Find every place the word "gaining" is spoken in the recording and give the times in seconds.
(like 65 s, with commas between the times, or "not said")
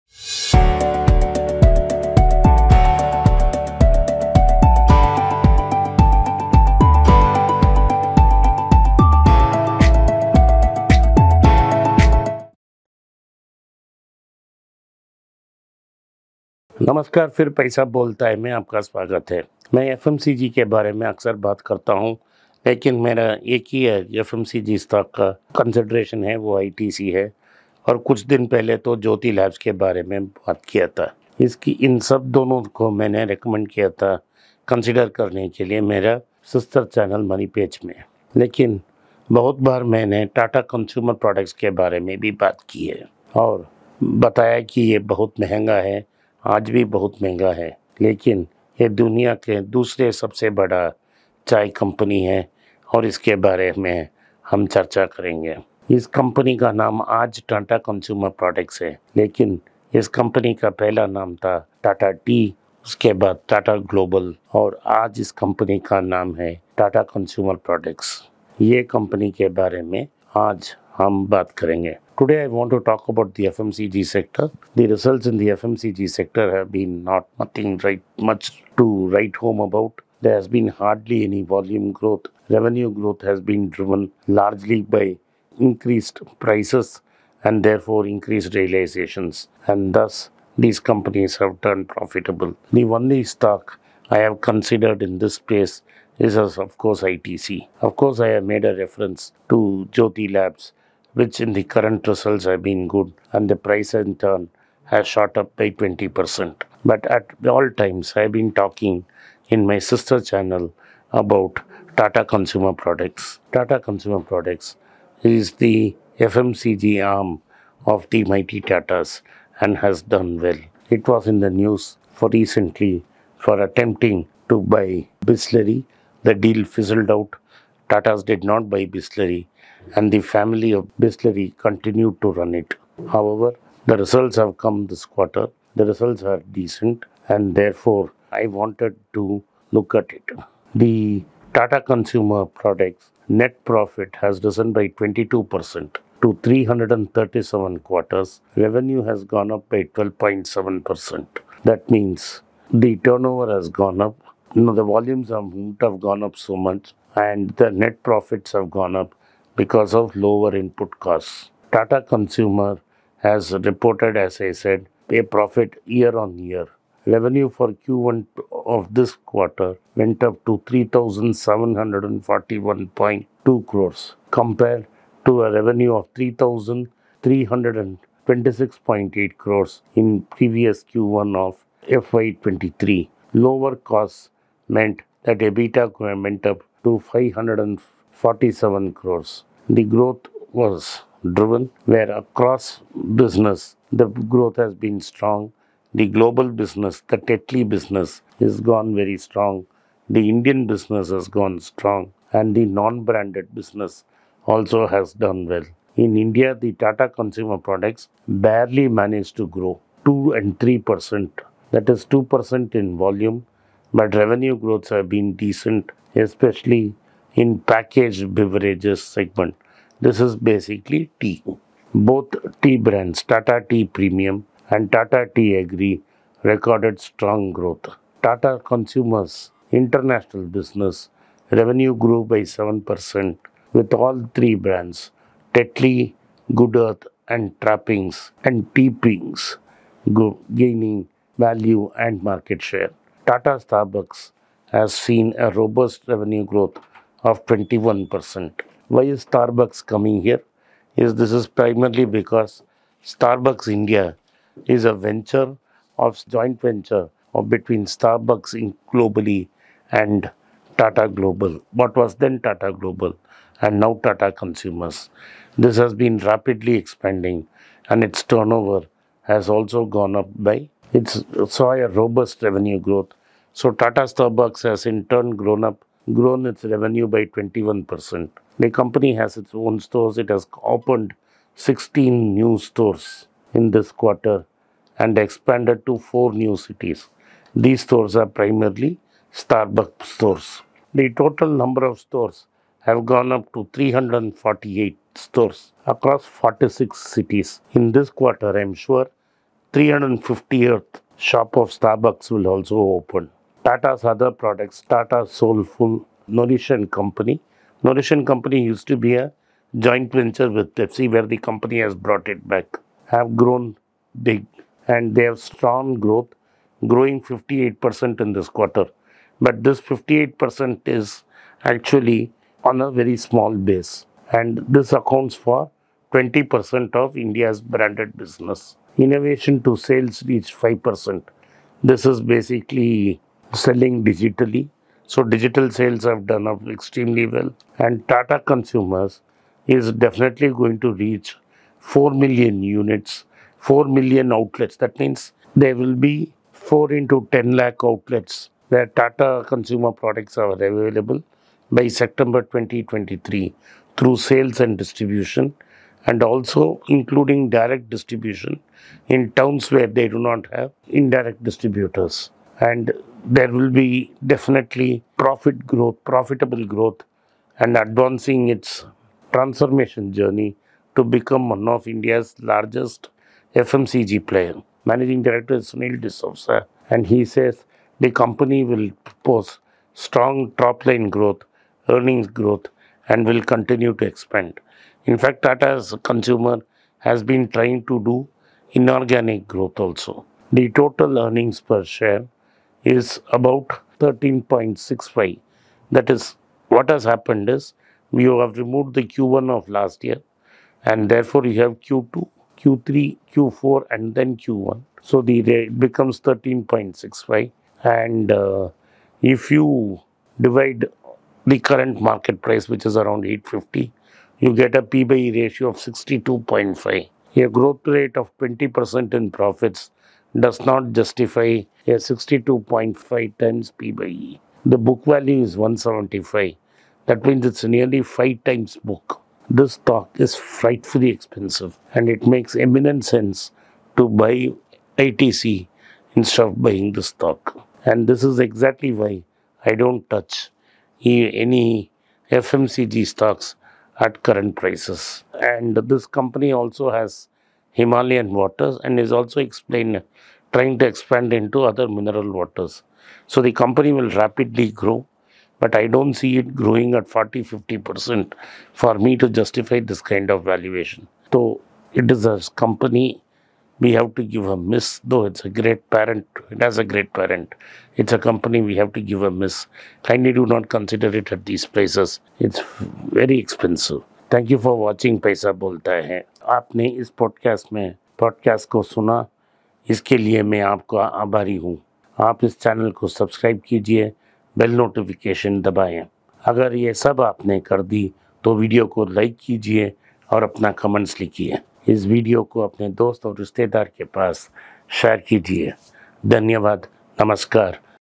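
240 s.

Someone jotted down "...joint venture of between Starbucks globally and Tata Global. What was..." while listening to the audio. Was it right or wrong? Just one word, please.
right.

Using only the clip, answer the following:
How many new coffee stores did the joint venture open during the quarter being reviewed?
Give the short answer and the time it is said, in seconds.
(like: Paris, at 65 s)
16, at 281 s.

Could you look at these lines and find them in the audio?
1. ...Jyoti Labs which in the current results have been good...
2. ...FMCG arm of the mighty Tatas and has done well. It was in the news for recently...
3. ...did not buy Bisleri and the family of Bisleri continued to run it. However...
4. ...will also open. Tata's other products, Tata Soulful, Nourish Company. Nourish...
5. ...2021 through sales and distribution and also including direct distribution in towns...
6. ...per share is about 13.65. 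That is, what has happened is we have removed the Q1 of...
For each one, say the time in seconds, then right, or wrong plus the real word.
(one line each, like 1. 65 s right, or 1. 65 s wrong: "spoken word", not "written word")
1. 99 s right
2. 116 s right
3. 128 s right
4. 302 s right
5. 352 s wrong: "2023", not "2021"
6. 391 s right.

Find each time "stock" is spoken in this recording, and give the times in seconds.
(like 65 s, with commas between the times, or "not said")
93 s, 429 s, 437 s, 443 s.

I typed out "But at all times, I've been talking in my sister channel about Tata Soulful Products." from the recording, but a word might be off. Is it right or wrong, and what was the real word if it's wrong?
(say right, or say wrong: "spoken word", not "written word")
wrong: "Consumer", not "Soulful".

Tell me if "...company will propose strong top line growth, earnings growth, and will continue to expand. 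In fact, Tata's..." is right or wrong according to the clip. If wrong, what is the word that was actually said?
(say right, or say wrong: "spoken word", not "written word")
right.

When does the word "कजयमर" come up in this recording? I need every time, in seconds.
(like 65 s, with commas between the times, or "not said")
40 s, 57 s, 67 s.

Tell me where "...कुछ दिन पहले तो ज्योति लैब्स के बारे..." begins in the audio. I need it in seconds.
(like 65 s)
28 s.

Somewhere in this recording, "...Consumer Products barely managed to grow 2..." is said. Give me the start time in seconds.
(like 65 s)
207 s.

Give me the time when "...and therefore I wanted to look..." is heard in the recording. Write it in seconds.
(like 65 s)
137 s.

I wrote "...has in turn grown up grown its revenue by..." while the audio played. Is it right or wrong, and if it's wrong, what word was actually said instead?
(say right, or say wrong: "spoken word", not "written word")
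right.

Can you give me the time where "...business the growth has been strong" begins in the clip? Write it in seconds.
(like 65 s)
193 s.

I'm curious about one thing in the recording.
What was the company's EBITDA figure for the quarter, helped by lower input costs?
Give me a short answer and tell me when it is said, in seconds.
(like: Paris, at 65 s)
547 crores, at 187 s.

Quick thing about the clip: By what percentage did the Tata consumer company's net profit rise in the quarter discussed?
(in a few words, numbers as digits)
22%.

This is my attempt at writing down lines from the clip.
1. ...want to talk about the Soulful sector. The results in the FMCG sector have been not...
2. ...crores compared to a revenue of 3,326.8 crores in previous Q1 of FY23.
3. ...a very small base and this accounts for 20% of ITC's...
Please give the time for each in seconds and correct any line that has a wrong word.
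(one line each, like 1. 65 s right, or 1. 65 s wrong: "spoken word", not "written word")
1. 72 s wrong: "FMCG", not "Soulful"
2. 173 s right
3. 322 s wrong: "India", not "ITC".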